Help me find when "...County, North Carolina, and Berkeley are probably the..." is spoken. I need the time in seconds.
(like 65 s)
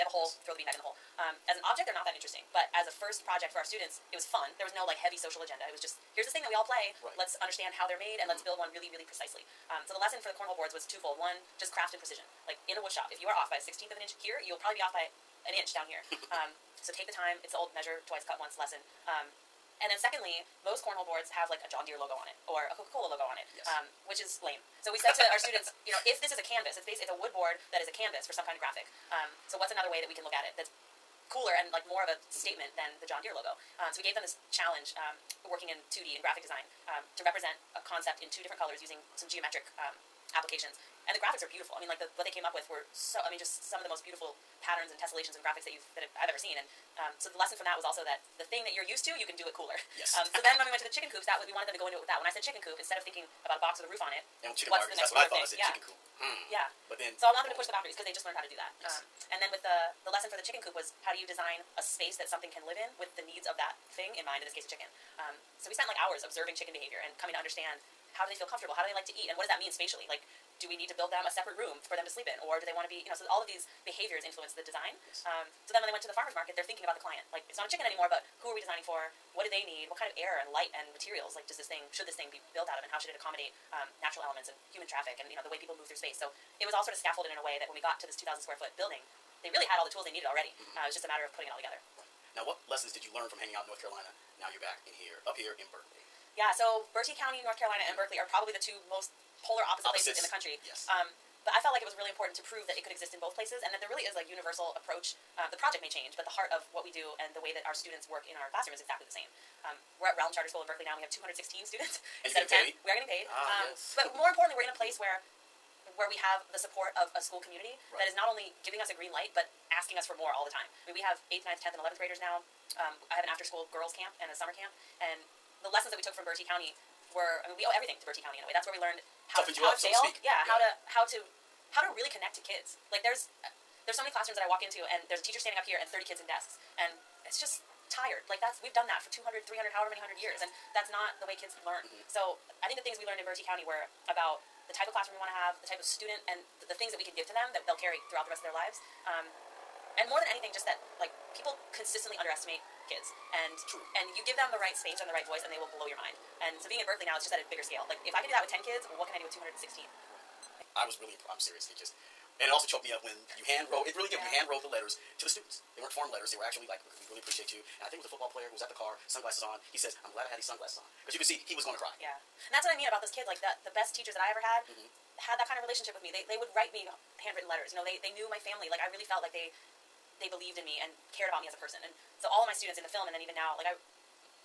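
97 s.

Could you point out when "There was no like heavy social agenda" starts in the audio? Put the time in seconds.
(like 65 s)
4 s.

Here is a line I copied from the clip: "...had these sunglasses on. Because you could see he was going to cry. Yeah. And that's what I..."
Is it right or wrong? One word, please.
right.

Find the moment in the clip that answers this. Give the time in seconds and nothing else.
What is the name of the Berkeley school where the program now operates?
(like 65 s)
110 s.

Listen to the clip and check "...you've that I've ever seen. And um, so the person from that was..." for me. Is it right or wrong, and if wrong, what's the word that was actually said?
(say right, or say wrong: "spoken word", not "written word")
wrong: "lesson", not "person".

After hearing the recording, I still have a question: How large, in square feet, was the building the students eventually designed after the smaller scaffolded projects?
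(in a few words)
2,000 square feet.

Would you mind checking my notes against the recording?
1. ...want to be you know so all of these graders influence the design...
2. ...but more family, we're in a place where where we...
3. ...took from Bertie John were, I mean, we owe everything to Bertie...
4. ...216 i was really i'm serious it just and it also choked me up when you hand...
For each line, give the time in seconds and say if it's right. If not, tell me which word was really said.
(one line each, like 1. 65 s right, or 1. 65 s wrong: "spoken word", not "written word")
1. 72 s wrong: "behaviors", not "graders"
2. 113 s wrong: "importantly", not "family"
3. 126 s wrong: "County", not "John"
4. 159 s right.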